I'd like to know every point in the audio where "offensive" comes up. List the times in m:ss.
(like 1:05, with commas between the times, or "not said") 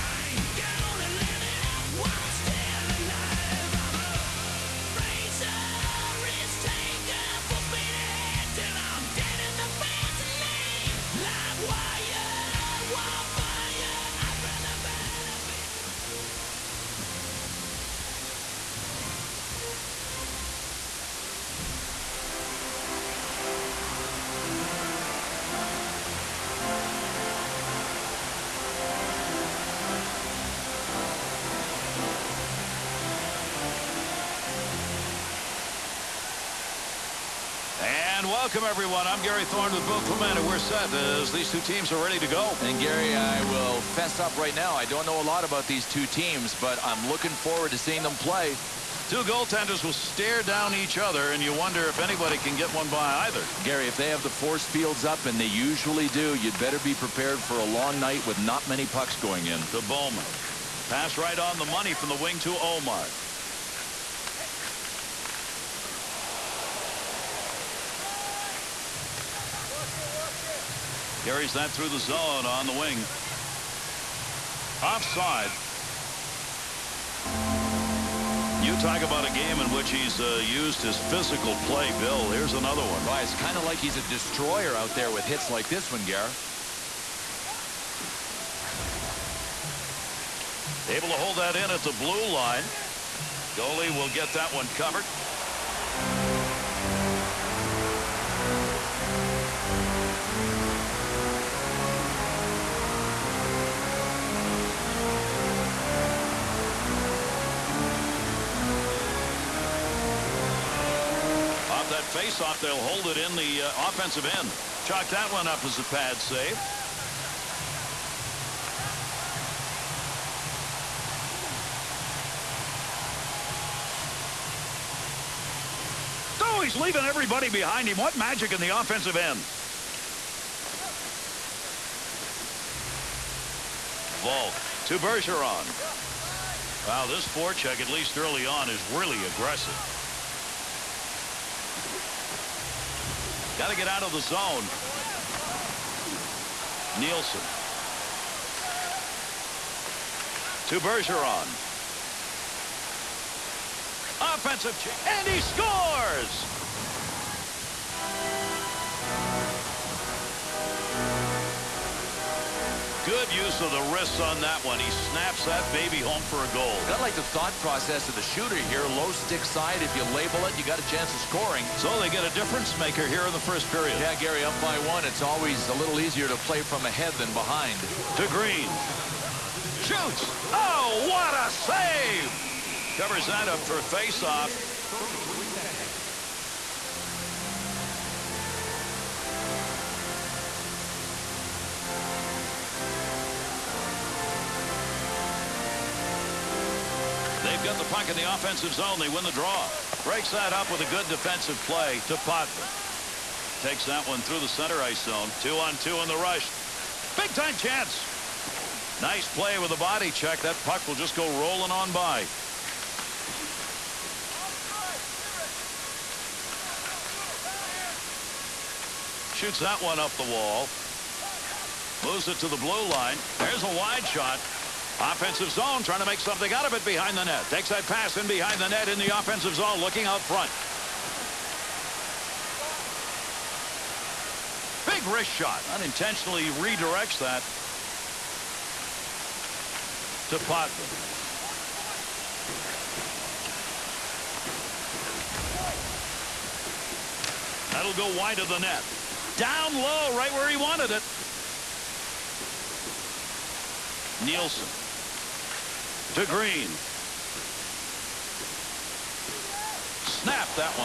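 1:53, 2:08, 2:34, 3:18, 3:45, 3:49.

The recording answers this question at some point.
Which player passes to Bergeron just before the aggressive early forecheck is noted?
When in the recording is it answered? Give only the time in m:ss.
2:14.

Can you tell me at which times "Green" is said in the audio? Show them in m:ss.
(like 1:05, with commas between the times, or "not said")
2:58, 4:16.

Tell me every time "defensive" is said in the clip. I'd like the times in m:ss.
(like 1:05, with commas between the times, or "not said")
3:21.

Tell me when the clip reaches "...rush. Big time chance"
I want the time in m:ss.
3:26.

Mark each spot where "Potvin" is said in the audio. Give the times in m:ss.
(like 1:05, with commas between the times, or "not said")
3:22, 4:00.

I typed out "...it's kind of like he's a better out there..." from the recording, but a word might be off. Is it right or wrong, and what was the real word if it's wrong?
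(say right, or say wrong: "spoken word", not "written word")
wrong: "destroyer", not "better".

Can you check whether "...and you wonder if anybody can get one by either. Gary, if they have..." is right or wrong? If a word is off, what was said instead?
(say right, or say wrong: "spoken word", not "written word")
right.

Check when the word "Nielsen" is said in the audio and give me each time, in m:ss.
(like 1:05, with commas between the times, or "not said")
2:26, 4:14.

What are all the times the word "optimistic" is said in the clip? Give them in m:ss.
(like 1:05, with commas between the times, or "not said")
not said.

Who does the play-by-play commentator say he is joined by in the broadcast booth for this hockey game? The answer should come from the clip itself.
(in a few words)
Bill Clement.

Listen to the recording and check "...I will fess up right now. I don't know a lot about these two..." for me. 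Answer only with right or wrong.
right.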